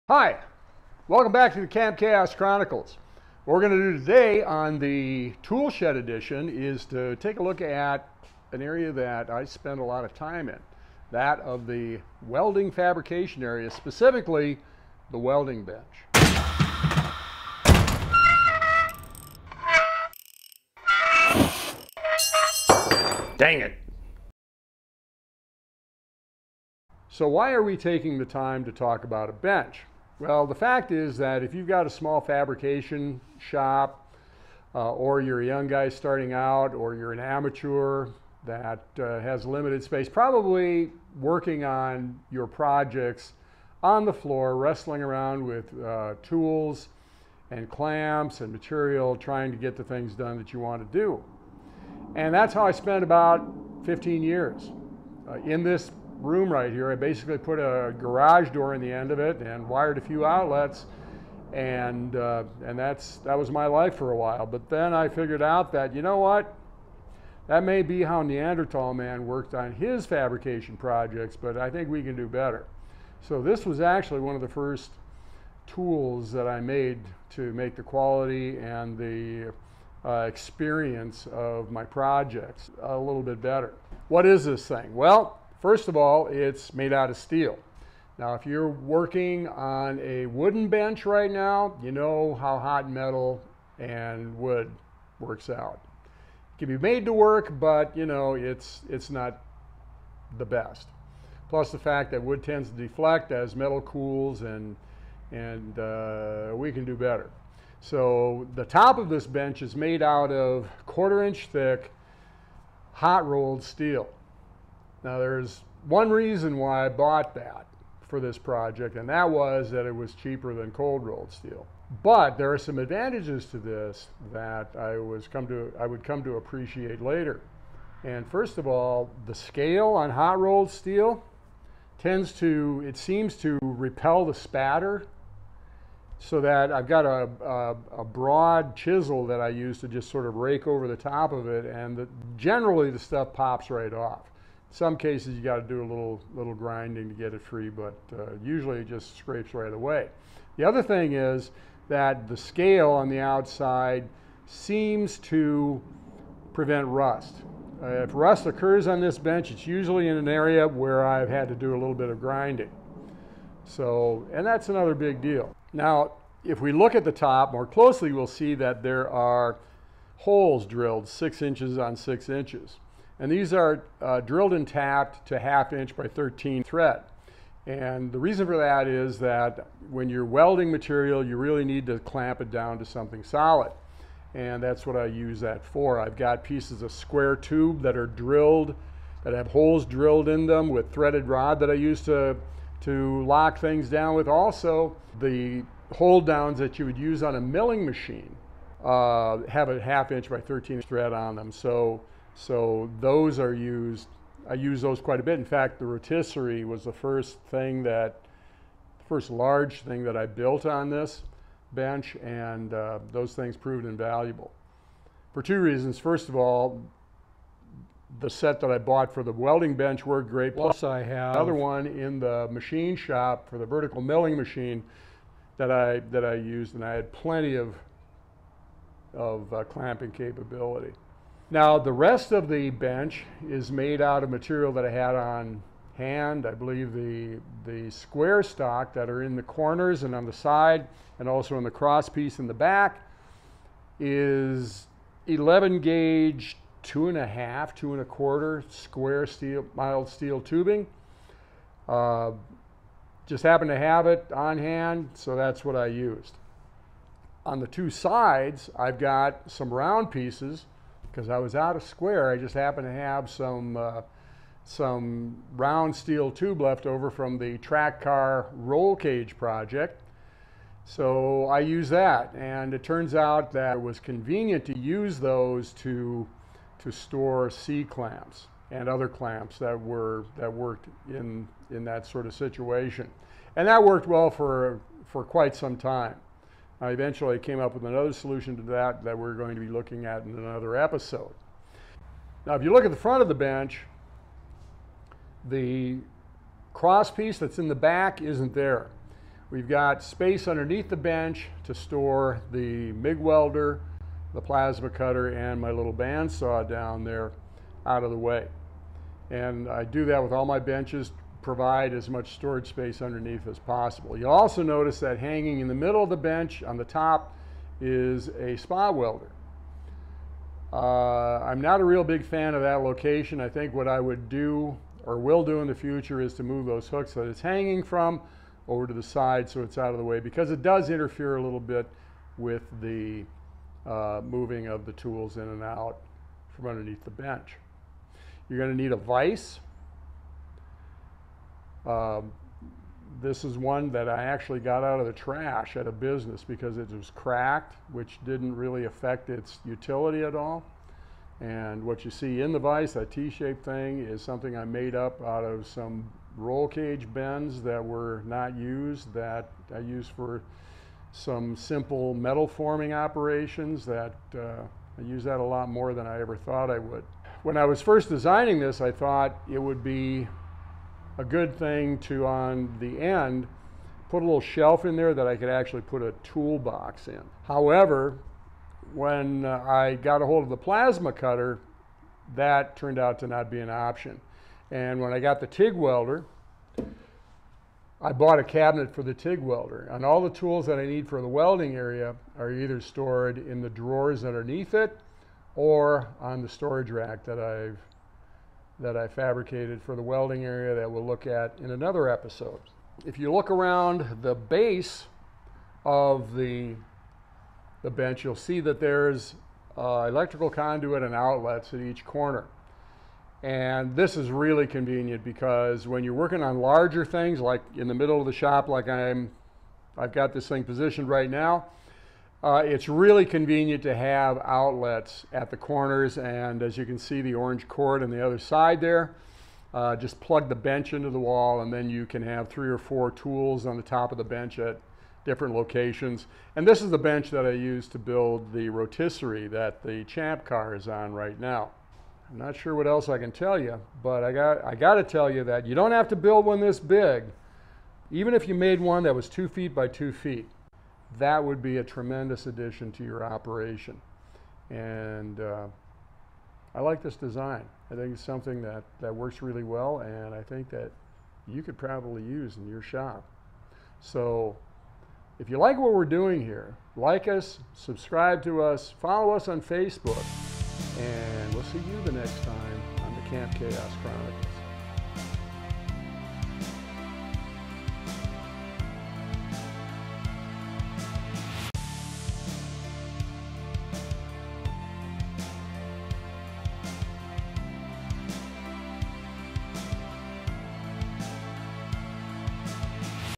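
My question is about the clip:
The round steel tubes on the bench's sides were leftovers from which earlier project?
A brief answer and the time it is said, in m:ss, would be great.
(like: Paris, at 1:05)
track car roll cage, at 4:27.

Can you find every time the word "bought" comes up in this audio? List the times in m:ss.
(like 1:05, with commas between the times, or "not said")
1:56, 3:38, 6:28.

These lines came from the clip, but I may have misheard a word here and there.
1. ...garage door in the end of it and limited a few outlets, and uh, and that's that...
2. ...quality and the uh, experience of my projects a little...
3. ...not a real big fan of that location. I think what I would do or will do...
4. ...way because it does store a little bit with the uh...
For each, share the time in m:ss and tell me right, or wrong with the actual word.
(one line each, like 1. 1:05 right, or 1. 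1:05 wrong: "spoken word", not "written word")
1. 0:57 wrong: "wired", not "limited"
2. 1:17 right
3. 5:21 right
4. 5:30 wrong: "interfere", not "store".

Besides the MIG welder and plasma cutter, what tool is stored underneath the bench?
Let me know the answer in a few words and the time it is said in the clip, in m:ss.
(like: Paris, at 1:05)
bandsaw, at 5:05.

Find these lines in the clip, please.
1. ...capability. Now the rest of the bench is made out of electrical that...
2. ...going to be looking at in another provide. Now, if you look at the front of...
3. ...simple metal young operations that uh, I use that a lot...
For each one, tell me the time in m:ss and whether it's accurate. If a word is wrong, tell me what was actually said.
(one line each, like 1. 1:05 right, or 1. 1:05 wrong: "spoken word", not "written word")
1. 3:50 wrong: "material", not "electrical"
2. 4:49 wrong: "episode", not "provide"
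3. 6:01 wrong: "forming", not "young".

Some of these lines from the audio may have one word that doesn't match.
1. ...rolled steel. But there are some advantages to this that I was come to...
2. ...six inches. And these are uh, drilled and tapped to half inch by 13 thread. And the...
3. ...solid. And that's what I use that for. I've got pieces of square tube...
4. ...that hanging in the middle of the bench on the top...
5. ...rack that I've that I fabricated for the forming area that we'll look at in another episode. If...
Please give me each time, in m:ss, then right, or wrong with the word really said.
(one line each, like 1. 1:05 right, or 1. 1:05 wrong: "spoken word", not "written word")
1. 2:01 right
2. 2:51 right
3. 3:03 right
4. 5:14 right
5. 6:36 wrong: "welding", not "forming".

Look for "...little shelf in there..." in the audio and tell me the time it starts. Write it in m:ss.
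6:14.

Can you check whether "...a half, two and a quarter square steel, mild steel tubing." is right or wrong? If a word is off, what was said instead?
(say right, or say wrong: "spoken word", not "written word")
right.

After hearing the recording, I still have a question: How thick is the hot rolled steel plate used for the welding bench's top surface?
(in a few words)
quarter inch.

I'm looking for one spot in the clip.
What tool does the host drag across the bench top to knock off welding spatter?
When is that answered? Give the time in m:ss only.
2:18.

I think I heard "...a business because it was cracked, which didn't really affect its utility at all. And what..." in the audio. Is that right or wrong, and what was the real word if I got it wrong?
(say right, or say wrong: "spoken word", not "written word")
right.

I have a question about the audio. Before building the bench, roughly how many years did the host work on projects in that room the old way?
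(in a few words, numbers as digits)
15 years.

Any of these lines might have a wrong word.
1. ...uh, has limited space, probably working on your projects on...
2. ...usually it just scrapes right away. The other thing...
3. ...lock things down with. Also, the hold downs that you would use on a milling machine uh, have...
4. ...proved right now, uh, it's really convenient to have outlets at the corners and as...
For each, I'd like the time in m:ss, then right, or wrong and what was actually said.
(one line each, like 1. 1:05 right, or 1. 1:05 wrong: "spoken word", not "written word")
1. 0:38 right
2. 2:28 right
3. 3:13 right
4. 7:00 wrong: "positioned", not "proved".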